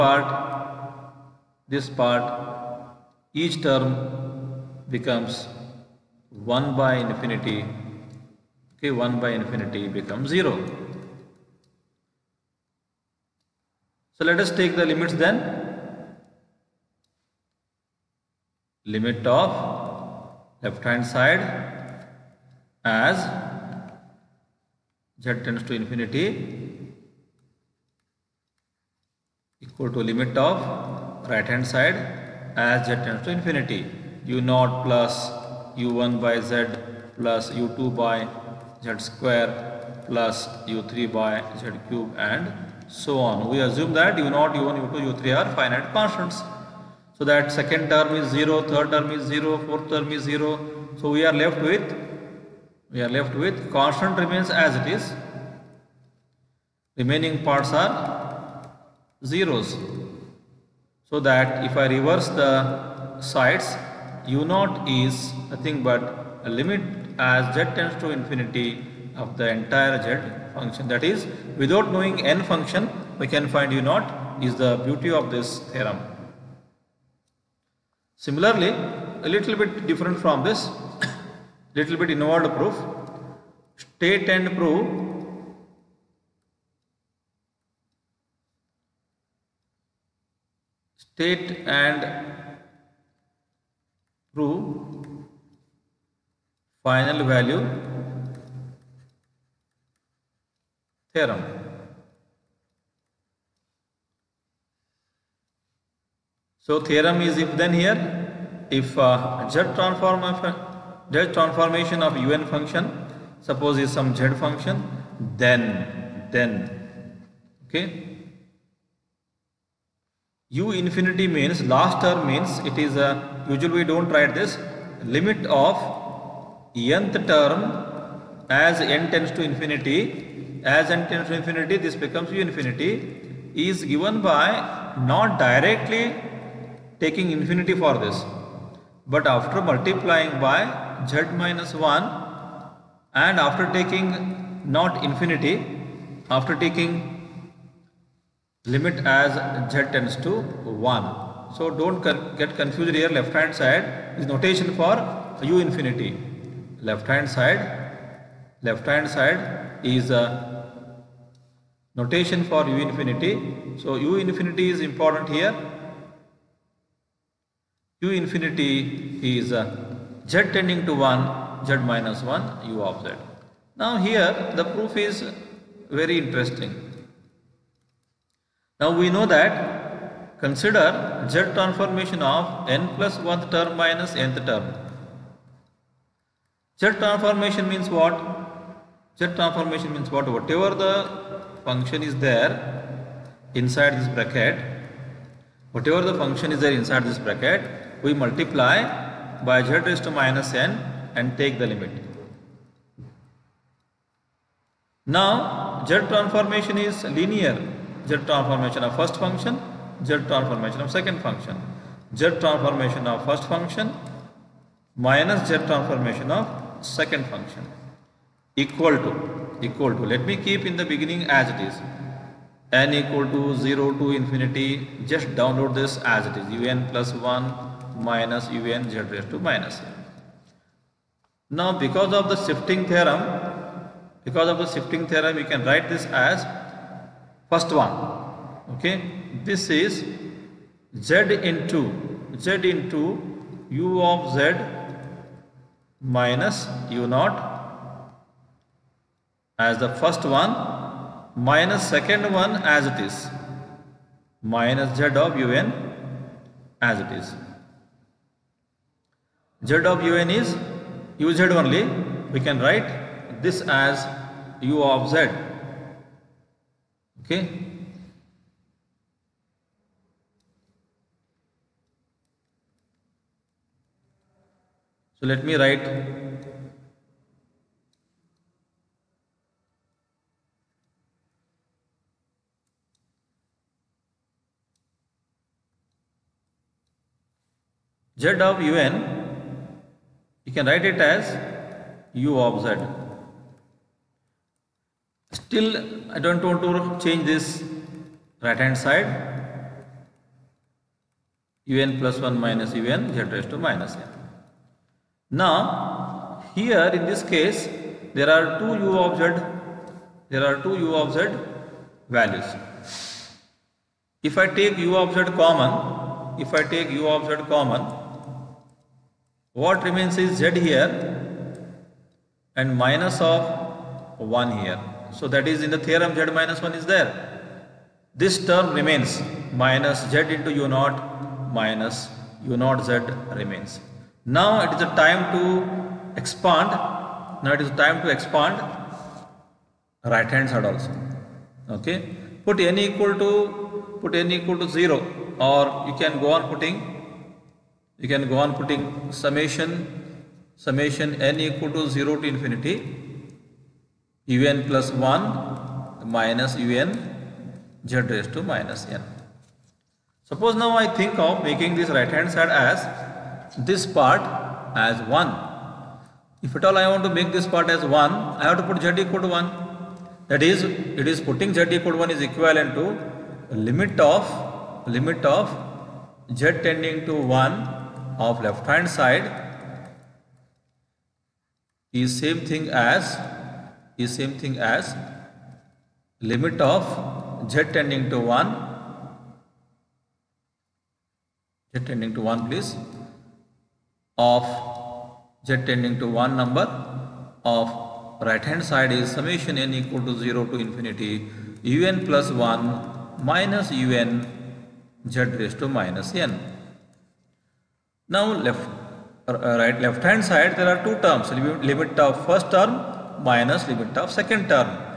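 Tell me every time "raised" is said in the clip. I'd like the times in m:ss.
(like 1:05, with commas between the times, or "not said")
3:19, 3:49, 5:03, 5:58, 6:45.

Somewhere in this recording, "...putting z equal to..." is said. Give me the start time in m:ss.
6:11.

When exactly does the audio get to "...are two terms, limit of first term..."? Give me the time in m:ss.
6:50.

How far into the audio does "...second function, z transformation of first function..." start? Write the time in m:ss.
3:30.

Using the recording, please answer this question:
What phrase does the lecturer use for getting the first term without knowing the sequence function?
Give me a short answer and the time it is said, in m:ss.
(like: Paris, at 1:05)
the beauty of this theorem, at 1:14.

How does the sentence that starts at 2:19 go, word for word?
But after multiplying by z minus 1 and after taking not infinity, after taking limit as z tends to 1.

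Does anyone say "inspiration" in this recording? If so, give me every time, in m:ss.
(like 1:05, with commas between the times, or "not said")
not said.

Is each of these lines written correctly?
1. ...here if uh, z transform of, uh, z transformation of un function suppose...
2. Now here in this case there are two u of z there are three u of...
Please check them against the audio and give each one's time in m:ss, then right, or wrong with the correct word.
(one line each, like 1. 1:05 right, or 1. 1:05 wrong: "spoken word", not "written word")
1. 1:47 right
2. 5:05 wrong: "two", not "three".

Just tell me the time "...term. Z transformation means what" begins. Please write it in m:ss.
3:04.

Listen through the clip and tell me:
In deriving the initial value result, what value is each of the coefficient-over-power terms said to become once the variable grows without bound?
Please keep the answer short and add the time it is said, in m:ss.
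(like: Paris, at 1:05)
0, at 0:09.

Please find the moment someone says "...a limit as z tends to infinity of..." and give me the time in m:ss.
1:06.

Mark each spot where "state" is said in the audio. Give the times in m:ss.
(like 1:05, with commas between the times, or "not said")
1:23, 1:30.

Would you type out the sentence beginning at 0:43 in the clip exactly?
We assume that u0, u1, u2, u3 are finite constants.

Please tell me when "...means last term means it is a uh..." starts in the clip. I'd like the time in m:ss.
2:01.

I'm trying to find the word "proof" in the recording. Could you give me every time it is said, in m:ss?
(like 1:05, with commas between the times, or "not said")
1:22, 2:54.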